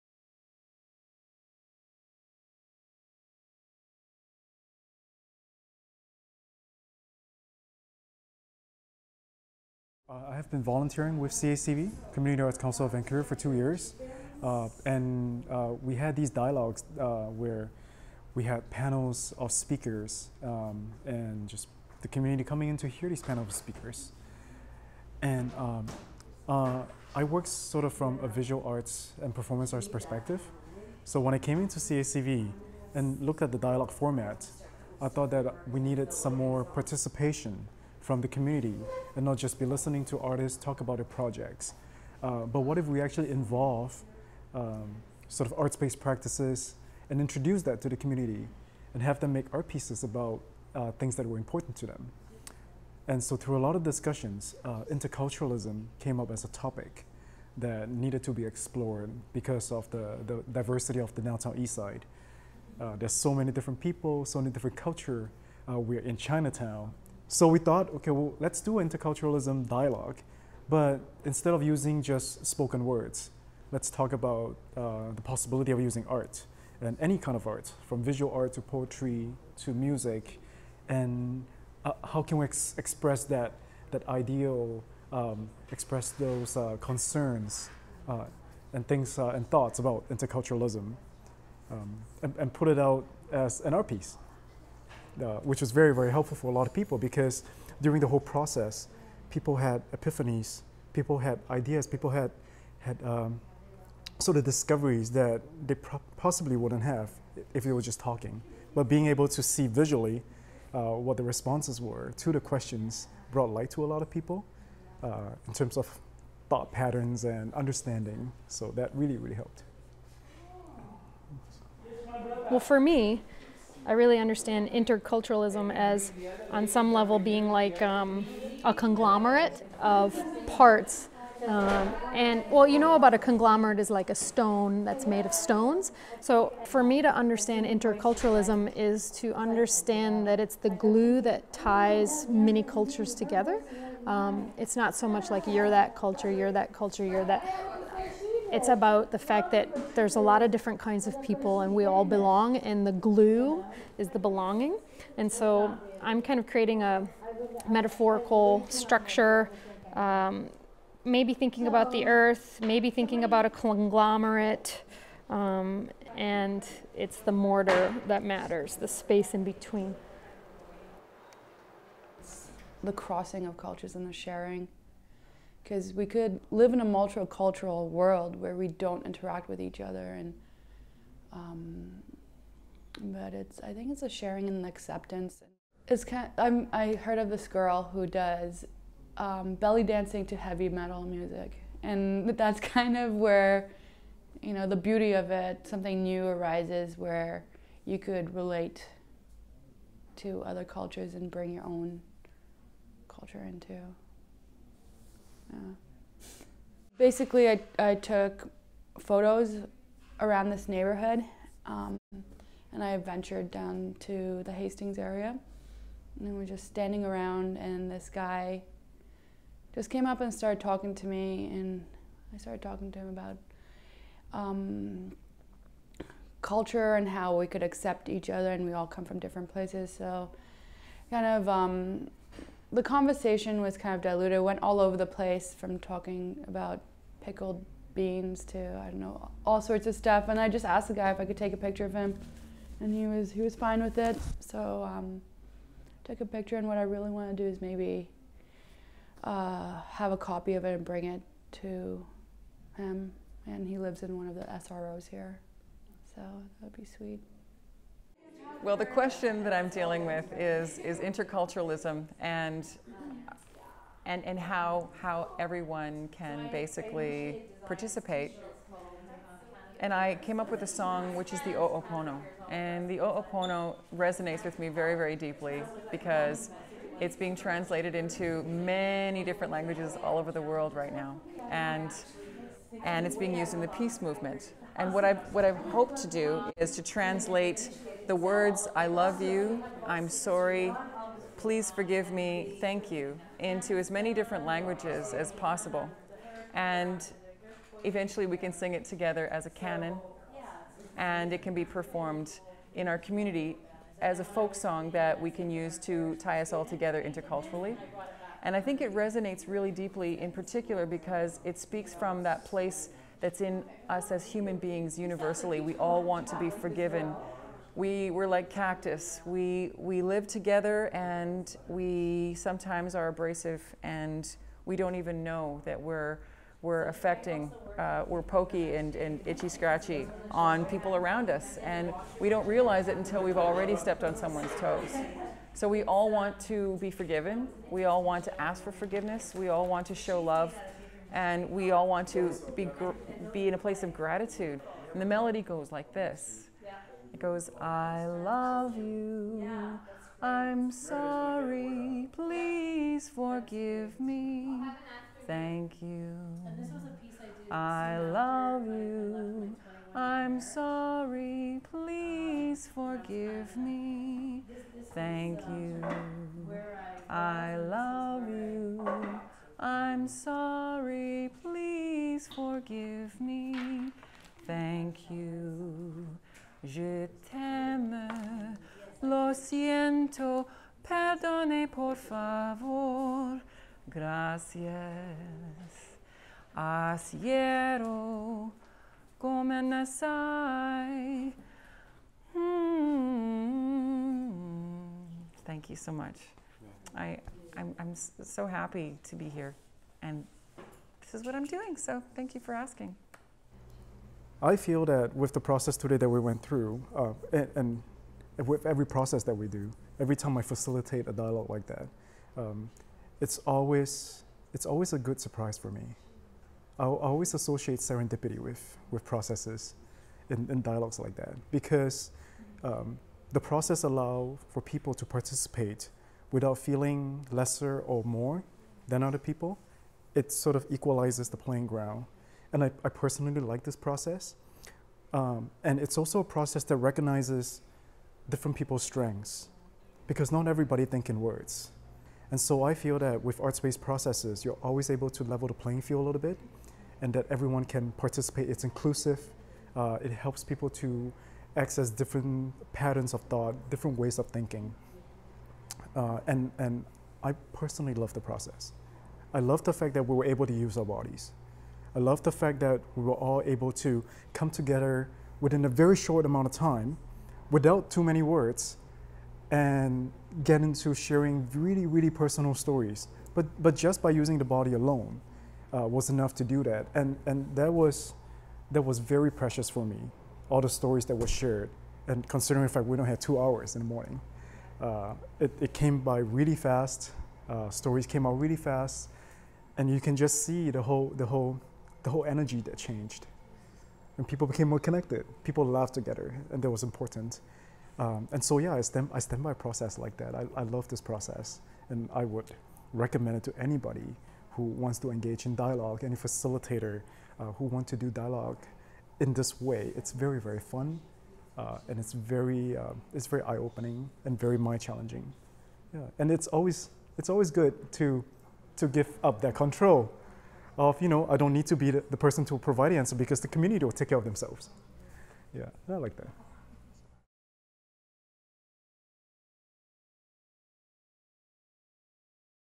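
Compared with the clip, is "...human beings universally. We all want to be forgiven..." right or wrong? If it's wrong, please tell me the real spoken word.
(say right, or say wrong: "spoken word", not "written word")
right.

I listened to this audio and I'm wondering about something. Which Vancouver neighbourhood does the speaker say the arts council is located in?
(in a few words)
Chinatown.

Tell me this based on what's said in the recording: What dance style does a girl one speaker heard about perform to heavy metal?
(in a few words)
belly dancing.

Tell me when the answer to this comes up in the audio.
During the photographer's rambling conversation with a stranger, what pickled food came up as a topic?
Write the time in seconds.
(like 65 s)
237 s.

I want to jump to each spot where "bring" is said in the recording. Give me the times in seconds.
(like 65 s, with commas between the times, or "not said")
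201 s, 250 s.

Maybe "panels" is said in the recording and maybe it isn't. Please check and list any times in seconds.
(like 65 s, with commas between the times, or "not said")
18 s, 23 s.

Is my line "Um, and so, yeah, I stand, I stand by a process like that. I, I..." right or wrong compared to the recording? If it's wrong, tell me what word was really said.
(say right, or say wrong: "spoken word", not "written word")
right.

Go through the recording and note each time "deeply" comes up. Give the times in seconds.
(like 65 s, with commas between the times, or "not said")
275 s, 309 s.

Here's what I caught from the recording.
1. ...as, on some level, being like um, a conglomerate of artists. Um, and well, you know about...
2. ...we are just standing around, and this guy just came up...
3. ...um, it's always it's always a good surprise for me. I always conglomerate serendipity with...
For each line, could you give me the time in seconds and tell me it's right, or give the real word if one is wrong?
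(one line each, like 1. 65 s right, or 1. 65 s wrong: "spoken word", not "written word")
1. 125 s wrong: "parts", not "artists"
2. 216 s right
3. 412 s wrong: "associate", not "conglomerate".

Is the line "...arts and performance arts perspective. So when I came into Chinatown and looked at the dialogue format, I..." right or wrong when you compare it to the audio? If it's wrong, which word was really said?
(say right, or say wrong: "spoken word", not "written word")
wrong: "CACV", not "Chinatown".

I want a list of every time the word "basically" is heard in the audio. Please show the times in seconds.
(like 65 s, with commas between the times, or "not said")
206 s, 266 s.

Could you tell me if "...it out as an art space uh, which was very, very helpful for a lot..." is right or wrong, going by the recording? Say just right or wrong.
wrong.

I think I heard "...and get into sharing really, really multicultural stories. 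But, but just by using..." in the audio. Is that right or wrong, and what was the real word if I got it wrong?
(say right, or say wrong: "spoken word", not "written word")
wrong: "personal", not "multicultural".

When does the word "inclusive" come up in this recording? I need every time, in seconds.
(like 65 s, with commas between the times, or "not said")
448 s.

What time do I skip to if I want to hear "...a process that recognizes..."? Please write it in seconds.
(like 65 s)
436 s.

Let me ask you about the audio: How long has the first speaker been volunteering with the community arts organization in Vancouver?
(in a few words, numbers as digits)
2 years.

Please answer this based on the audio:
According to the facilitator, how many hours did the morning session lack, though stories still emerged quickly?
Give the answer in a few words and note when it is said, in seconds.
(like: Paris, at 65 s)
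2 hours, at 483 s.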